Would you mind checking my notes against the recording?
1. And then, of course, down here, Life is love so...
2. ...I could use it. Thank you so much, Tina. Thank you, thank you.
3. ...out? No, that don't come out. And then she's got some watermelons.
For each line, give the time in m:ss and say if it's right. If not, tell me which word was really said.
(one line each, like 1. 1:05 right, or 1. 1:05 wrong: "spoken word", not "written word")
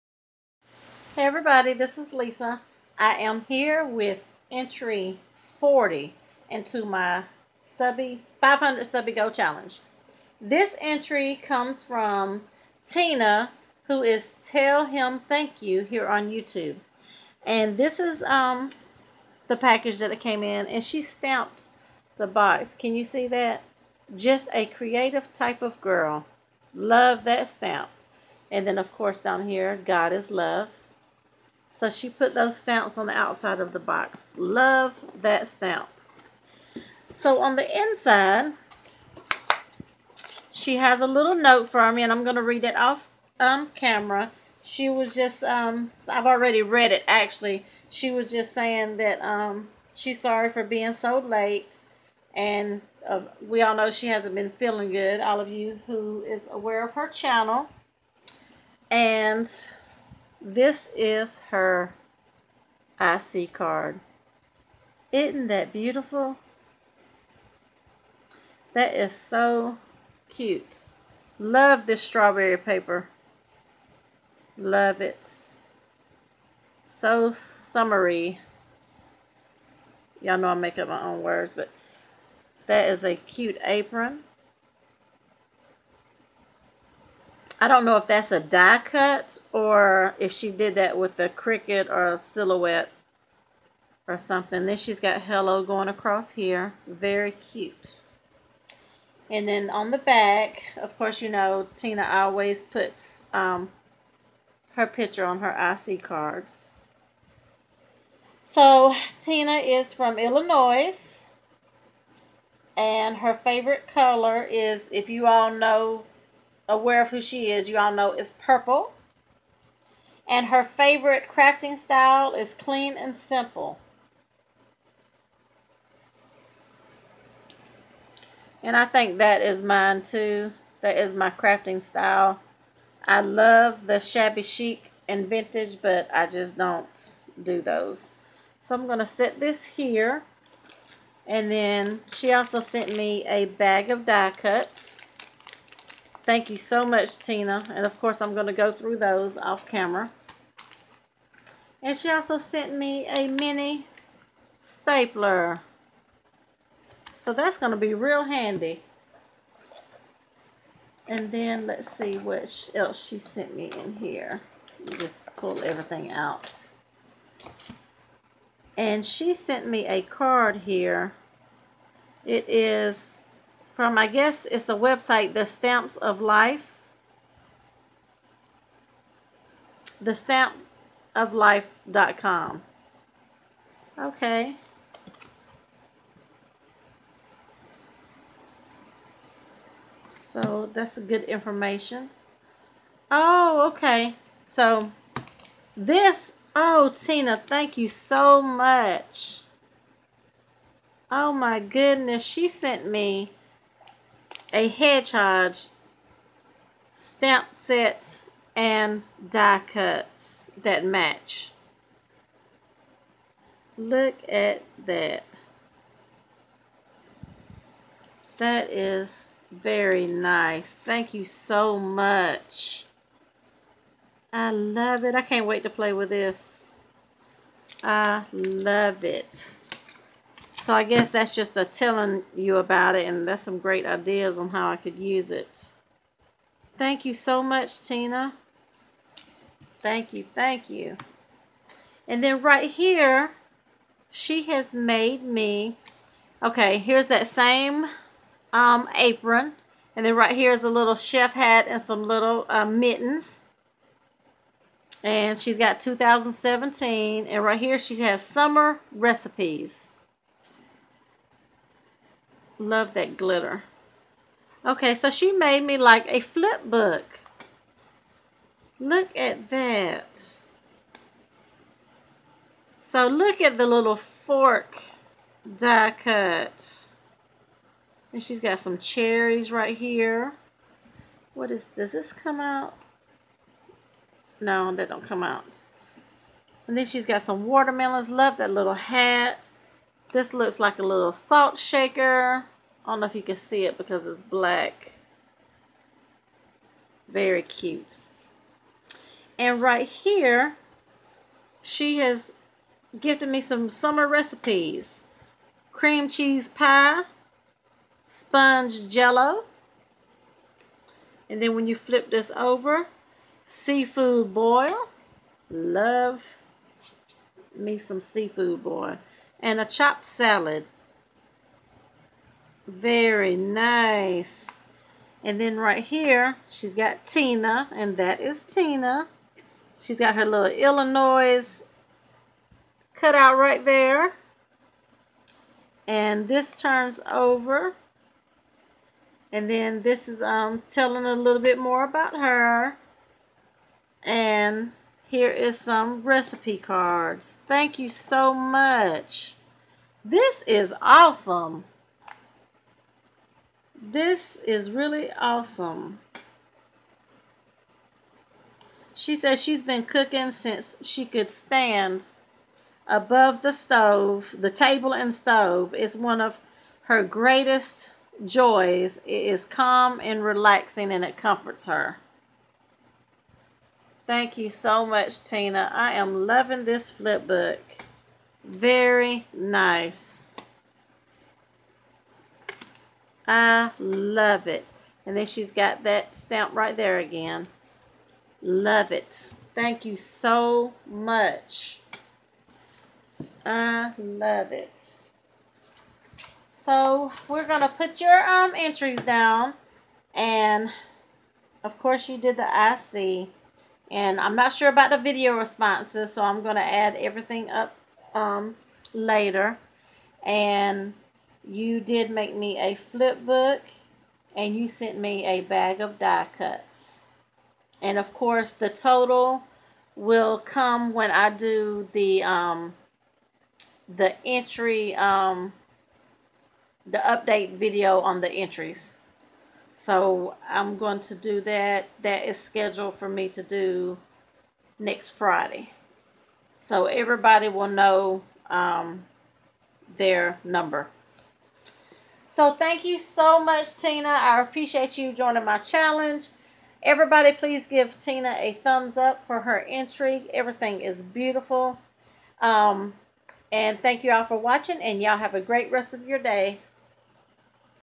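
1. 0:28 wrong: "God", not "Life"
2. 3:54 right
3. 4:42 right.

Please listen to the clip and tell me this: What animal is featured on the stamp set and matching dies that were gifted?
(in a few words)
Hedgehog.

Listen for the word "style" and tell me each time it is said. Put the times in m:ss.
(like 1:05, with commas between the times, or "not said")
2:01, 2:11.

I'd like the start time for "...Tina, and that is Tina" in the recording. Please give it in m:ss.
5:27.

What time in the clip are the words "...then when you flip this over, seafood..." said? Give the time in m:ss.
5:11.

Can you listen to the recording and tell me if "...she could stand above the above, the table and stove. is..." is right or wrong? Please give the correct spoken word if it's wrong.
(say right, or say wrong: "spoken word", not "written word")
wrong: "stove", not "above".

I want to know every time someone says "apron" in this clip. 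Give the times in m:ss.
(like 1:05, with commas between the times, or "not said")
1:23, 4:08.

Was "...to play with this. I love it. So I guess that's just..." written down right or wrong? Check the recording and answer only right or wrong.
right.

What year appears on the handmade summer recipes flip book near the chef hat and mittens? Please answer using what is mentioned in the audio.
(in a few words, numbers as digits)
2017.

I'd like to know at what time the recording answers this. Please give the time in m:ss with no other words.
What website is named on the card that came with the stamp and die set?
2:55.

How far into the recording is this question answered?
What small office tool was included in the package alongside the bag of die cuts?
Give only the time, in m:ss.
2:33.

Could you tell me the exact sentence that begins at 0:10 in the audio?
This entry comes from Tina, who is Tell Him Thank You here on YouTube.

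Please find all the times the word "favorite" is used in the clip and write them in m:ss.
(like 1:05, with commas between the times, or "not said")
1:53, 2:00.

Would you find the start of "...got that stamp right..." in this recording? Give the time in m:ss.
6:25.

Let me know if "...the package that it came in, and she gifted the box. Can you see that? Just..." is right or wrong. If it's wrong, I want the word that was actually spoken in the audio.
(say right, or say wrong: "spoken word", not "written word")
wrong: "stamped", not "gifted".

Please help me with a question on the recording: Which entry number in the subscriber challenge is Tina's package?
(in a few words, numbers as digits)
40.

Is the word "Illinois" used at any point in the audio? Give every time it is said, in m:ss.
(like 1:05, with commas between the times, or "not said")
1:50, 5:30.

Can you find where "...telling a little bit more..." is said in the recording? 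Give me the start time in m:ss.
5:40.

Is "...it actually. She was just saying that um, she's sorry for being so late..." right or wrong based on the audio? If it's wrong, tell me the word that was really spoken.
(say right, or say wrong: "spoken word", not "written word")
right.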